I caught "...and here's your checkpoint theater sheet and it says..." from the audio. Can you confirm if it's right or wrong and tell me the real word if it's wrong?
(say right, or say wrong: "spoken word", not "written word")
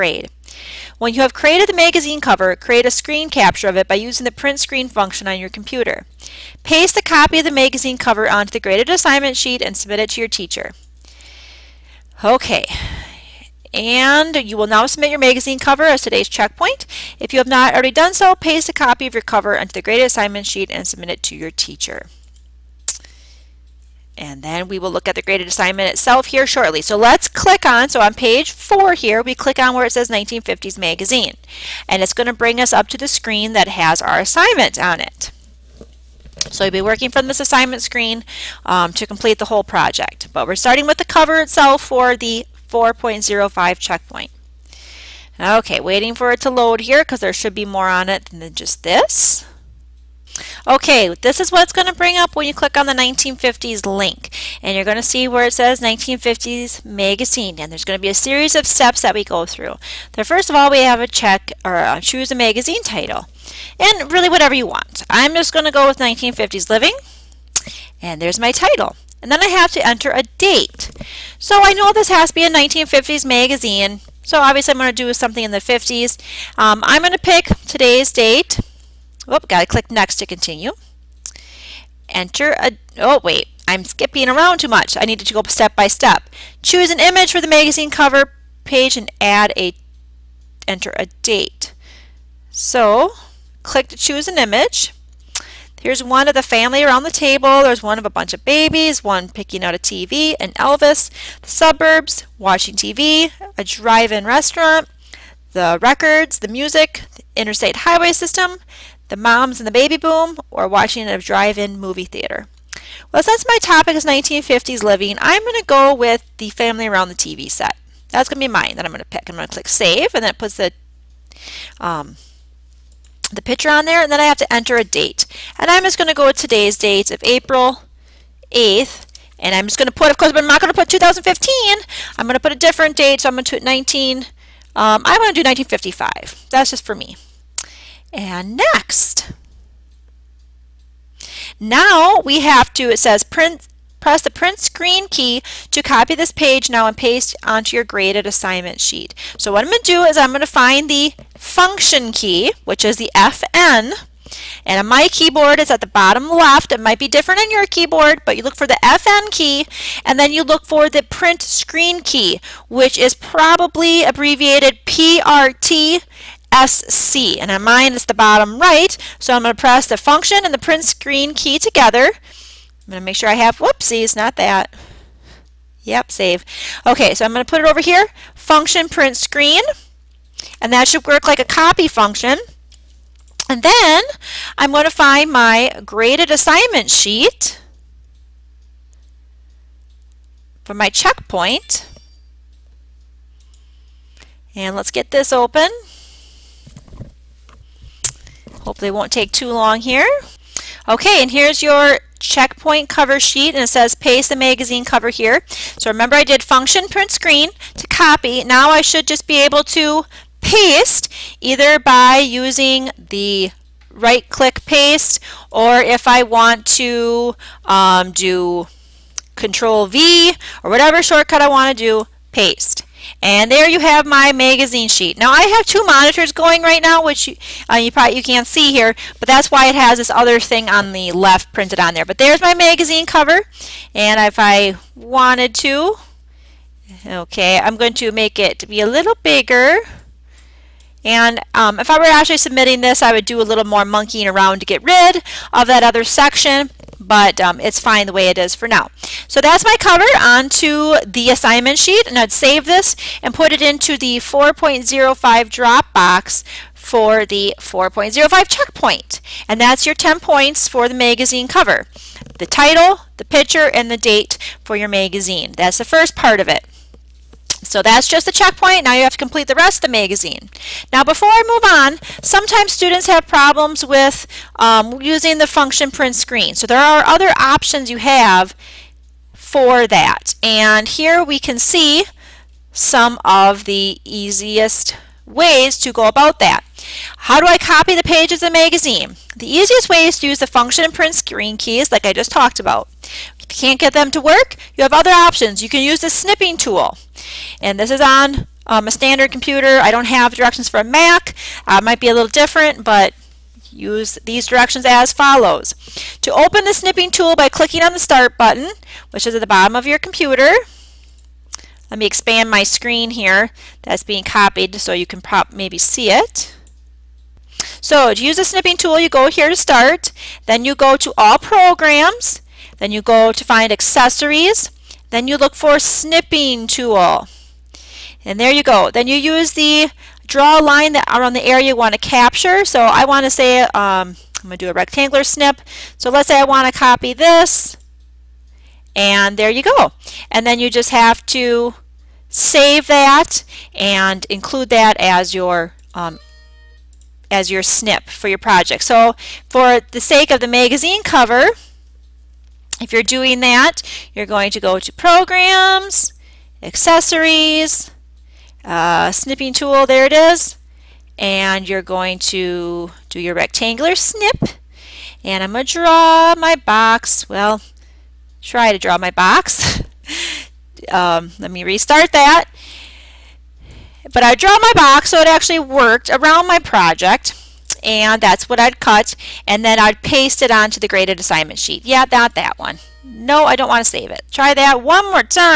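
wrong: "cover", not "theater".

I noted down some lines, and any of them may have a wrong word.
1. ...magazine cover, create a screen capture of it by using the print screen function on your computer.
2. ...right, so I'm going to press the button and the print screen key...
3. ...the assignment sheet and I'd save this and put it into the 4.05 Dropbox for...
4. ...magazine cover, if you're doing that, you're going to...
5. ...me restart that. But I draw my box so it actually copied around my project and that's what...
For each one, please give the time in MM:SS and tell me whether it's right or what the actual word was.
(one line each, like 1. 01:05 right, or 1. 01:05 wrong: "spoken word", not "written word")
1. 00:01 right
2. 02:48 wrong: "function", not "button"
3. 04:11 right
4. 05:50 right
5. 06:11 wrong: "worked", not "copied".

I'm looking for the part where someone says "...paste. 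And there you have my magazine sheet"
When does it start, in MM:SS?
03:42.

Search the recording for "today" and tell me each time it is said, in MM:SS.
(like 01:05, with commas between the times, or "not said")
00:16, 01:17, 02:06.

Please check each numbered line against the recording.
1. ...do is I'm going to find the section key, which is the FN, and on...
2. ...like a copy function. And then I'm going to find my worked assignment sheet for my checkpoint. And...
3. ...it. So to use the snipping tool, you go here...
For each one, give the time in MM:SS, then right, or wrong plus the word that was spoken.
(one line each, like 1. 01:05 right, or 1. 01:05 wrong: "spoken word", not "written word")
1. 02:29 wrong: "function", not "section"
2. 03:01 wrong: "graded", not "worked"
3. 05:16 right.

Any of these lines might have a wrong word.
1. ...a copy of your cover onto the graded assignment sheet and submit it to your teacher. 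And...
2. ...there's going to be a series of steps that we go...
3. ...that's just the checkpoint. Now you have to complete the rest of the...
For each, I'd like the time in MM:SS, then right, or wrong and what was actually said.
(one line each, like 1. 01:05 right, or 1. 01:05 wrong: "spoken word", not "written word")
1. 00:18 right
2. 00:57 right
3. 04:27 right.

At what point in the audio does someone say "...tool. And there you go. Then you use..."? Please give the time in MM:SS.
05:26.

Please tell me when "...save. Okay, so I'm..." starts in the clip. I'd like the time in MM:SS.
02:56.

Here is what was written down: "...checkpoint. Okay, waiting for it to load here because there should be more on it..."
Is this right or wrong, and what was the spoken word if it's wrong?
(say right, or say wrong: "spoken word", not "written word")
right.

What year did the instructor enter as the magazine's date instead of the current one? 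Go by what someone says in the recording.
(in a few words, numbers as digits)
1955.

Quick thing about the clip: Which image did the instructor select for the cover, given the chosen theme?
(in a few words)
family around the TV set.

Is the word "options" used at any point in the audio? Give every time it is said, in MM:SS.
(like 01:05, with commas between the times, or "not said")
04:37, 04:55.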